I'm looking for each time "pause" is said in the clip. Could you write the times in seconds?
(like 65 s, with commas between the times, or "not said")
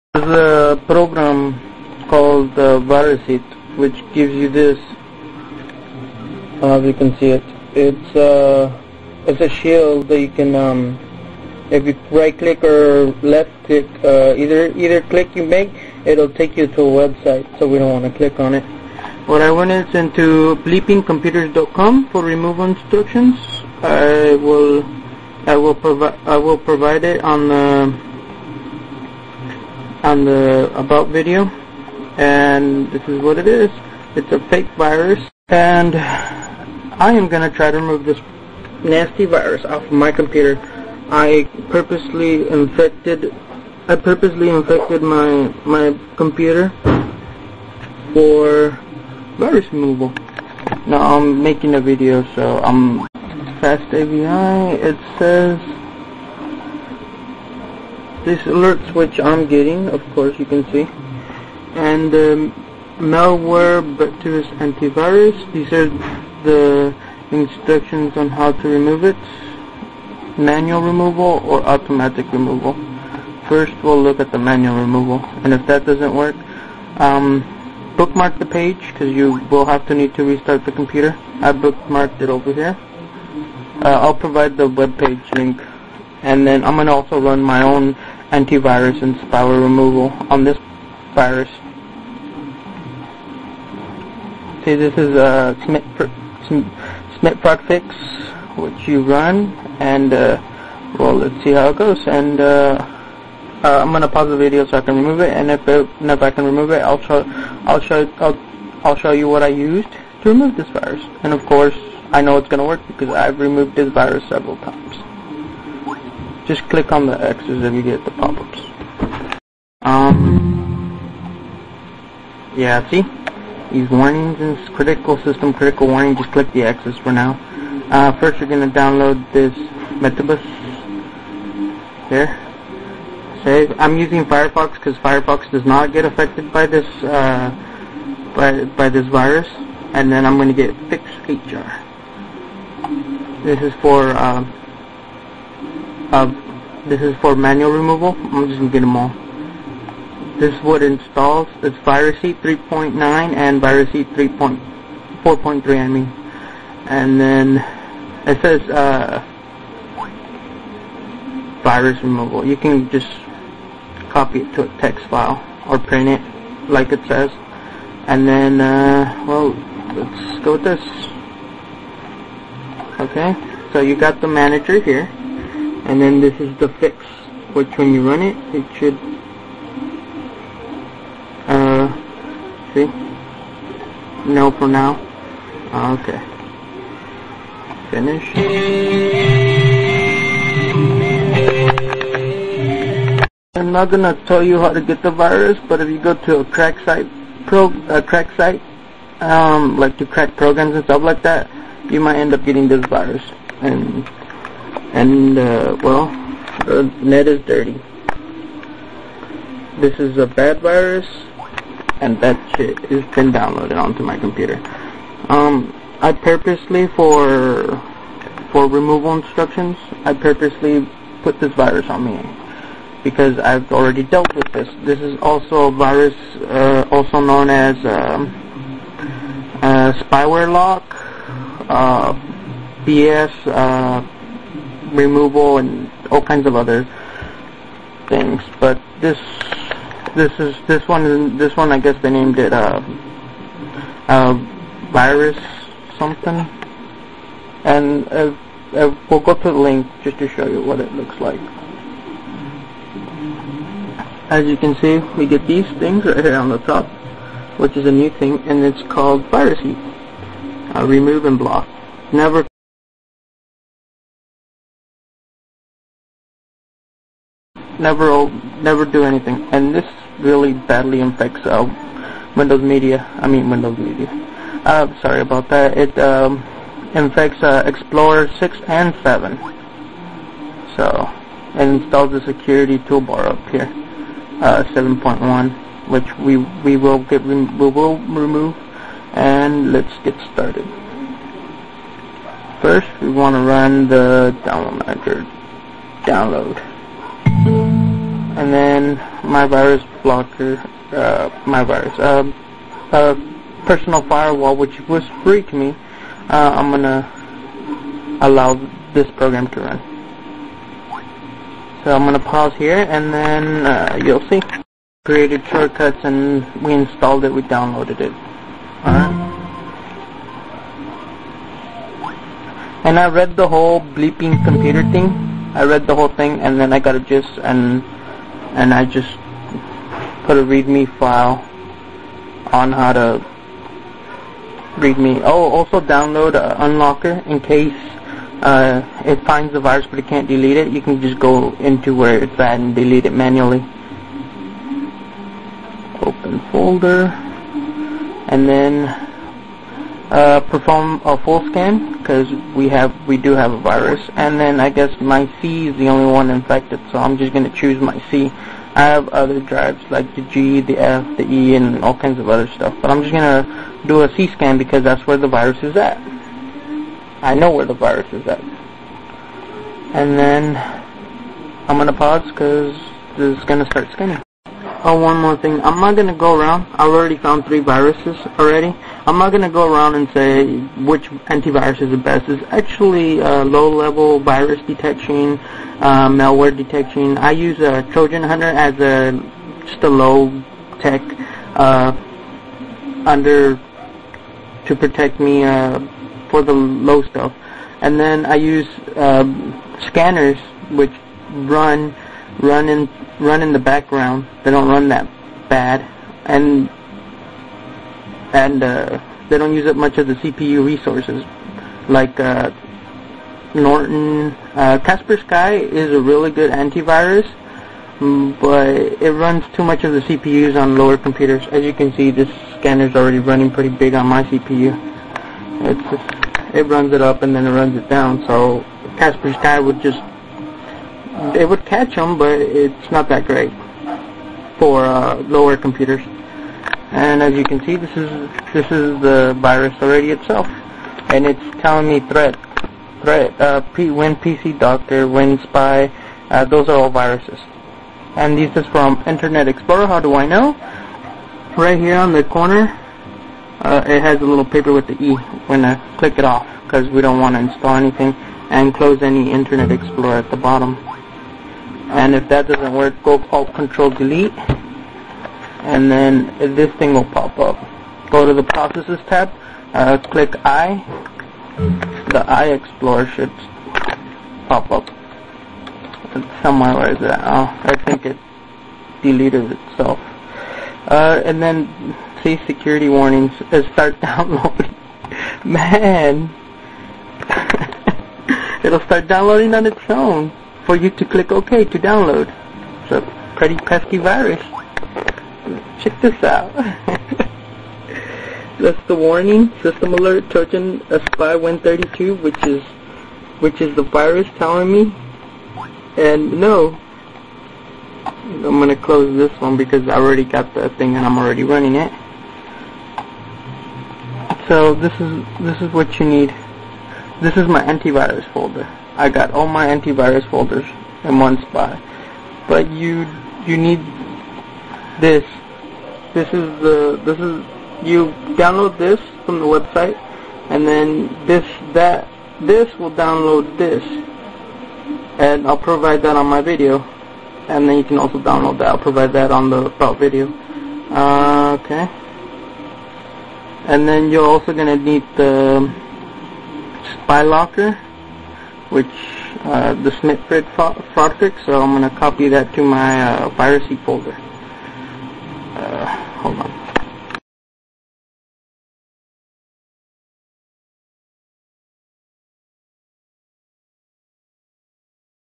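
104 s, 312 s, 371 s.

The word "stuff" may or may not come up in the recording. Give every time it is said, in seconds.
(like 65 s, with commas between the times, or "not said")
200 s, 362 s, 397 s.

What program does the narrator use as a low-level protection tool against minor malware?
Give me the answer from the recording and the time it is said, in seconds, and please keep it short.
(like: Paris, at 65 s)
Trojan Hunter, at 387 s.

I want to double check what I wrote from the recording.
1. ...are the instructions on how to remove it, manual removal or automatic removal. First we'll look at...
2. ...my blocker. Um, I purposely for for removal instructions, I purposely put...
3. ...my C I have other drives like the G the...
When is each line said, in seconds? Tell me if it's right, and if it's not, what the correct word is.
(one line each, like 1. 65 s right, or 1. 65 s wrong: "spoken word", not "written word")
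1. 65 s right
2. 214 s wrong: "computer", not "blocker"
3. 357 s right.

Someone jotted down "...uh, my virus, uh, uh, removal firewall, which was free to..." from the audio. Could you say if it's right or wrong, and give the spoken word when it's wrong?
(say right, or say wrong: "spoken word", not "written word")
wrong: "personal", not "removal".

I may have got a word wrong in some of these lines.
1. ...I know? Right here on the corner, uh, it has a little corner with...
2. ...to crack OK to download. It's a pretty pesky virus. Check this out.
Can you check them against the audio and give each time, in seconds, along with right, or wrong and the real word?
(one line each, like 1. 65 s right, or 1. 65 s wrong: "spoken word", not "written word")
1. 450 s wrong: "paper", not "corner"
2. 490 s wrong: "click", not "crack".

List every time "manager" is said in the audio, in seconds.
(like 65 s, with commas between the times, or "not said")
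174 s, 294 s.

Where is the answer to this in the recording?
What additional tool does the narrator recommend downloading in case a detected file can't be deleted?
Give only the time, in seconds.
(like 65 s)
336 s.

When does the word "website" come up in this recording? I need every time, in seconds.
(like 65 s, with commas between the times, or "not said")
17 s, 529 s.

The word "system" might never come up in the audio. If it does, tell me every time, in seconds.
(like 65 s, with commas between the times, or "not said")
125 s, 499 s.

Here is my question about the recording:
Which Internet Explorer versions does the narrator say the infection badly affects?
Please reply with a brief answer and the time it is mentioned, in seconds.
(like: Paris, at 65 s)
6 and 7, at 277 s.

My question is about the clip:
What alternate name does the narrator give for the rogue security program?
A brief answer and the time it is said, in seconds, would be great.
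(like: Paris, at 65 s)
spyware lock, at 229 s.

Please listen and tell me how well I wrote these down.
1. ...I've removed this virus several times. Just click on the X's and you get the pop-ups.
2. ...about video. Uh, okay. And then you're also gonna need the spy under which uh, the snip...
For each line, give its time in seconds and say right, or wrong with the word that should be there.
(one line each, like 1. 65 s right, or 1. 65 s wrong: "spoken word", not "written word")
1. 113 s right
2. 539 s wrong: "locker", not "under".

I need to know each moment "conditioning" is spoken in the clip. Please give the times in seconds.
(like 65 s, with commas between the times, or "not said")
not said.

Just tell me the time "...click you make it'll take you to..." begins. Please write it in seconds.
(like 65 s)
15 s.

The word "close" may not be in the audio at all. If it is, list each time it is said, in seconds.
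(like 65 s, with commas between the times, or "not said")
458 s, 508 s.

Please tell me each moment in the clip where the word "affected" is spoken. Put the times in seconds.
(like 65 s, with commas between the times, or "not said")
136 s.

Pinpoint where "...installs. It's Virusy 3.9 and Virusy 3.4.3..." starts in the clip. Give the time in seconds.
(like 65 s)
150 s.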